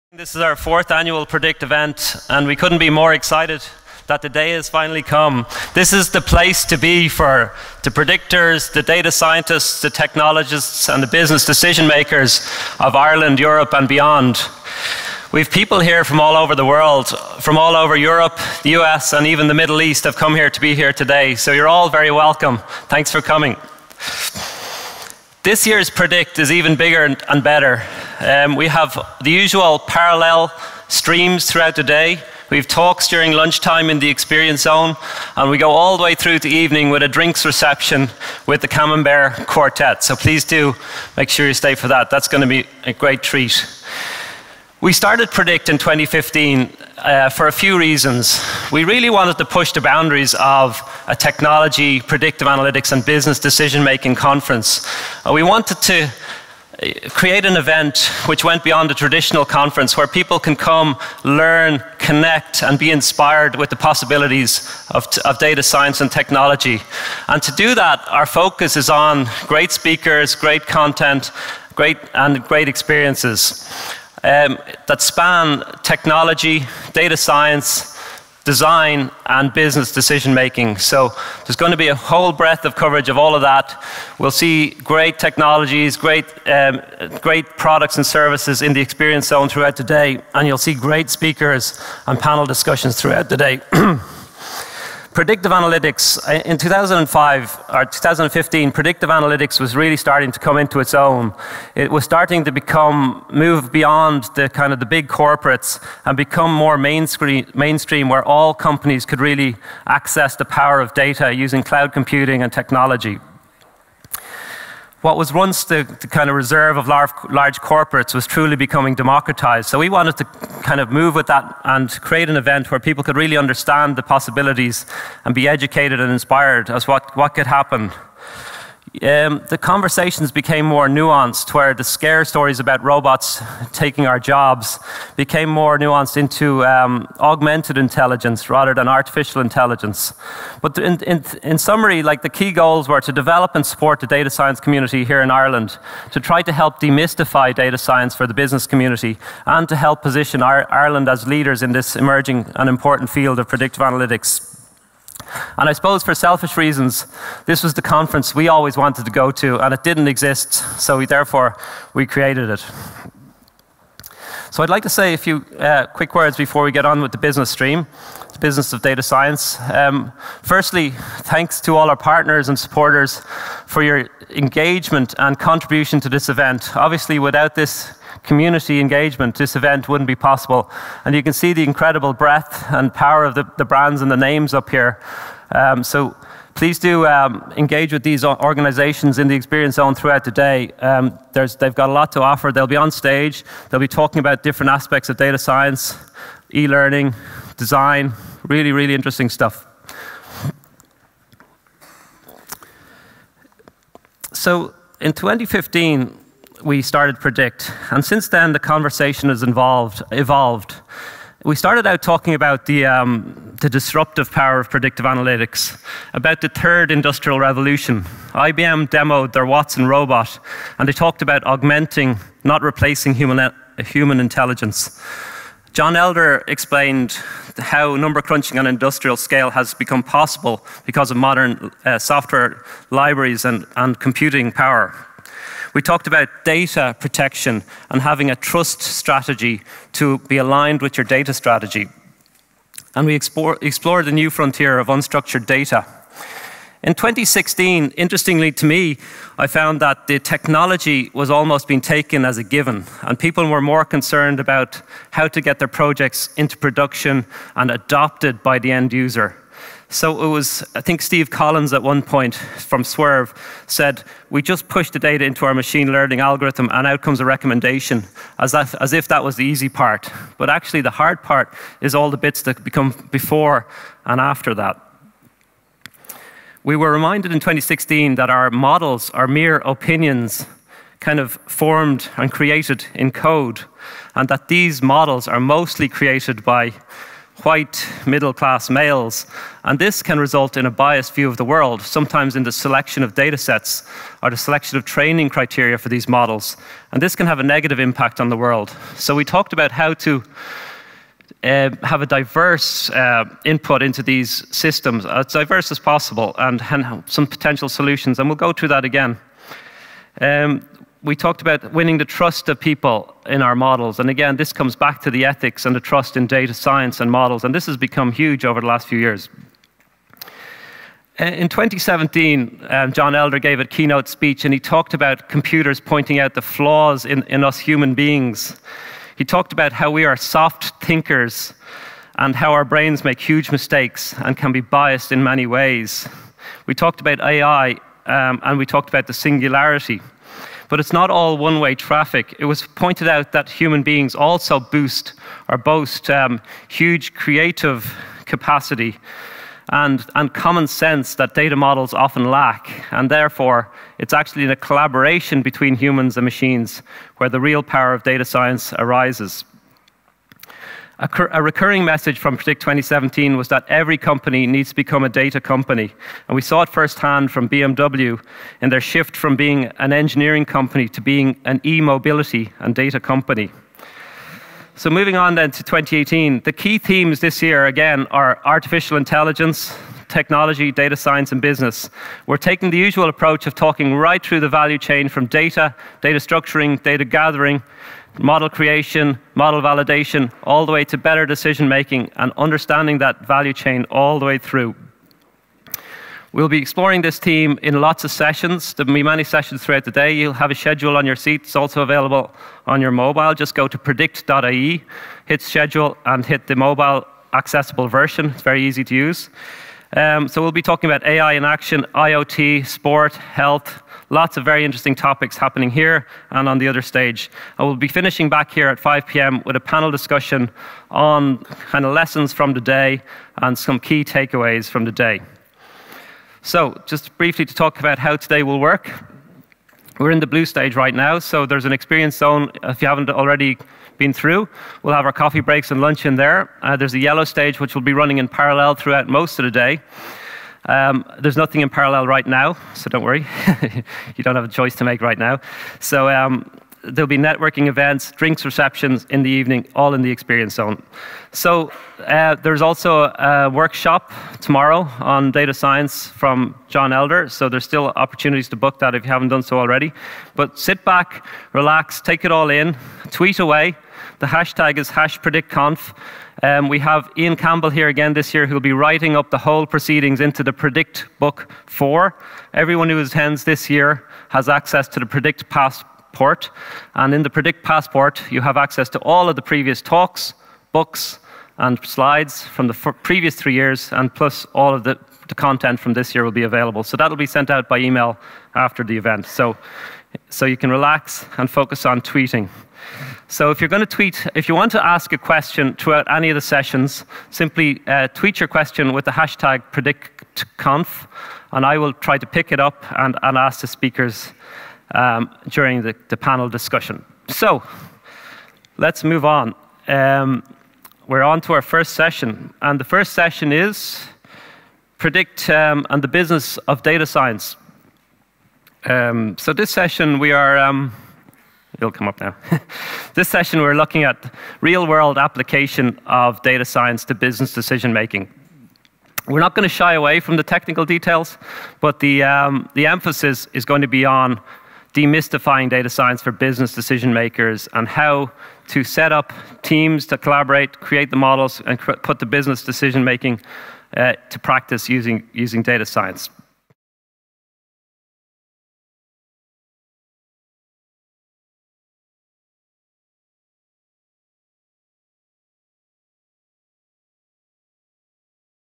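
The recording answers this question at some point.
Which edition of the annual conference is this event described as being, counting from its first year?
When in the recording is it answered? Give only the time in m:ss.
0:00.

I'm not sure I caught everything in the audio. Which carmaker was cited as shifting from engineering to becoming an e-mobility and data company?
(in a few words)
BMW.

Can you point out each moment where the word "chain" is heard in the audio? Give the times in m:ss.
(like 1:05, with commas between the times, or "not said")
6:24, 6:33.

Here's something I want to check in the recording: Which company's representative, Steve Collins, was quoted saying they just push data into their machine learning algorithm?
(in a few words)
Swrve.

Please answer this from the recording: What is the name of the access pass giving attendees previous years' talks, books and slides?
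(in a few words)
Predict Passport.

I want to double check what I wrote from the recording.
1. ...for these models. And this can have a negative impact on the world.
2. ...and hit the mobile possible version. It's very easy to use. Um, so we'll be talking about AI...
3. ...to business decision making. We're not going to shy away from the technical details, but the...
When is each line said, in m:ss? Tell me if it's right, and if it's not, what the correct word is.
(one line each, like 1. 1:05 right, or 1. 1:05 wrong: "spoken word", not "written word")
1. 4:55 right
2. 6:46 wrong: "accessible", not "possible"
3. 8:47 right.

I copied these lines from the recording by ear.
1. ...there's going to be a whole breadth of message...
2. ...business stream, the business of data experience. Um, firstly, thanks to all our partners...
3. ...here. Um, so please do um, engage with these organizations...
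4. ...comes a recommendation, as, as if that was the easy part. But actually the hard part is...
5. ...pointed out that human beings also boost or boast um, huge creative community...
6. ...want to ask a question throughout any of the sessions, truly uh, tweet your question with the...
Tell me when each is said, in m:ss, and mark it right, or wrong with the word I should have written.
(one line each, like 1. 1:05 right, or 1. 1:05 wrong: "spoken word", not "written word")
1. 1:21 wrong: "coverage", not "message"
2. 2:47 wrong: "science", not "experience"
3. 3:04 right
4. 4:27 right
5. 5:42 wrong: "capacity", not "community"
6. 8:14 wrong: "simply", not "truly".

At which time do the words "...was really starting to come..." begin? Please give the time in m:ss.
1:39.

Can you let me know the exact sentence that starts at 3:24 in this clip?
So in 2015, we started Predict.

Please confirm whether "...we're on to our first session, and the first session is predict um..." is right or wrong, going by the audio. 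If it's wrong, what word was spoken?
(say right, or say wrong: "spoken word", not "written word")
right.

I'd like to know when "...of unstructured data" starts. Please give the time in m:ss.
4:04.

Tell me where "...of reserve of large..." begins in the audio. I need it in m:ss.
1:56.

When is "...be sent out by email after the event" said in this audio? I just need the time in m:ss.
8:07.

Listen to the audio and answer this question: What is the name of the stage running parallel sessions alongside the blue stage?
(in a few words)
yellow stage.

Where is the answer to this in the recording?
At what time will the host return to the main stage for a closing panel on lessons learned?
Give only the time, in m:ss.
6:58.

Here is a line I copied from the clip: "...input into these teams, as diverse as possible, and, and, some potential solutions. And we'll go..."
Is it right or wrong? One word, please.
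wrong.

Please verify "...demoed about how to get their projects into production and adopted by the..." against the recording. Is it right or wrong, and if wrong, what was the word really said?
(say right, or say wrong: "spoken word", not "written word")
wrong: "concerned", not "demoed".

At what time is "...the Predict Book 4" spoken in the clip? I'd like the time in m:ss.
7:50.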